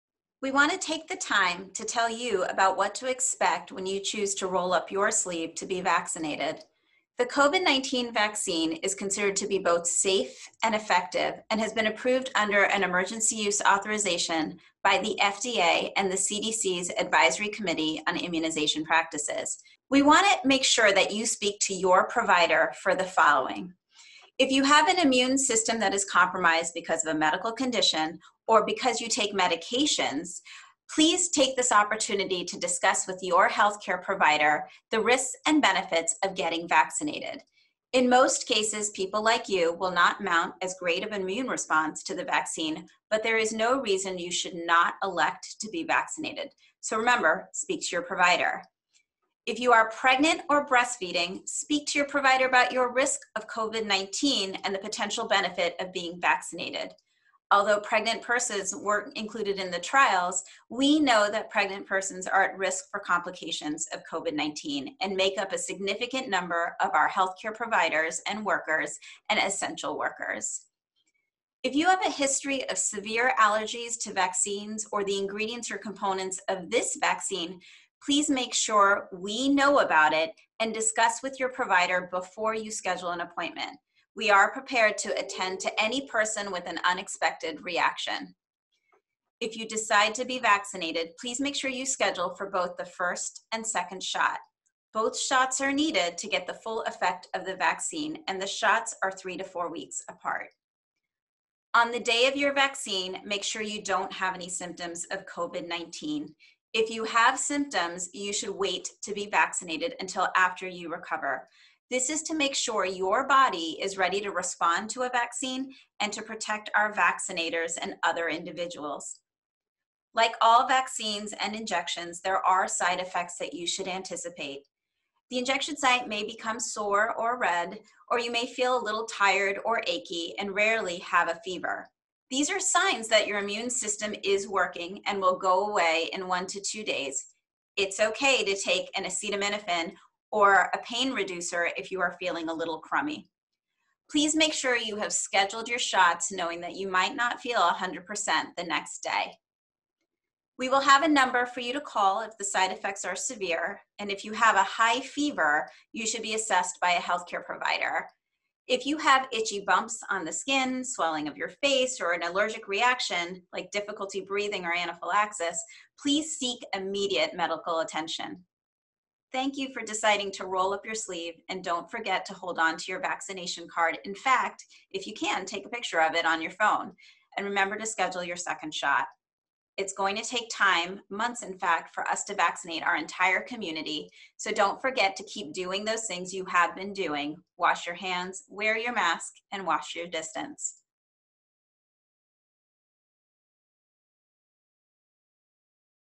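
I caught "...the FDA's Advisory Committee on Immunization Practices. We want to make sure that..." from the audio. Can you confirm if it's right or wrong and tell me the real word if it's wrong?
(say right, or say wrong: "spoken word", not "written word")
wrong: "CDC", not "FDA".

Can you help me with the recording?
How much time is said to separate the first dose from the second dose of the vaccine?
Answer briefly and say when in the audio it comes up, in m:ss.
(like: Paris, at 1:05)
3 to 4 weeks, at 1:39.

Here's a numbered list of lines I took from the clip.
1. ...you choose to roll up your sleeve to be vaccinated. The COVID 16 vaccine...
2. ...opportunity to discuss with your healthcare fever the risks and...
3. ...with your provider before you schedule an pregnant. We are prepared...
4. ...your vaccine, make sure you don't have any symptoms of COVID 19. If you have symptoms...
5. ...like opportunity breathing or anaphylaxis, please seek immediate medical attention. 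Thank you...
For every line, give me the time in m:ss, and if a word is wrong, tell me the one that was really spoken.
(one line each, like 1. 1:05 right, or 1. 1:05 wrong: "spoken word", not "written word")
1. 0:03 wrong: "19", not "16"
2. 0:31 wrong: "provider", not "fever"
3. 1:21 wrong: "appointment", not "pregnant"
4. 1:42 right
5. 2:43 wrong: "difficulty", not "opportunity".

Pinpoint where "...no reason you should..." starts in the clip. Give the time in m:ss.
0:43.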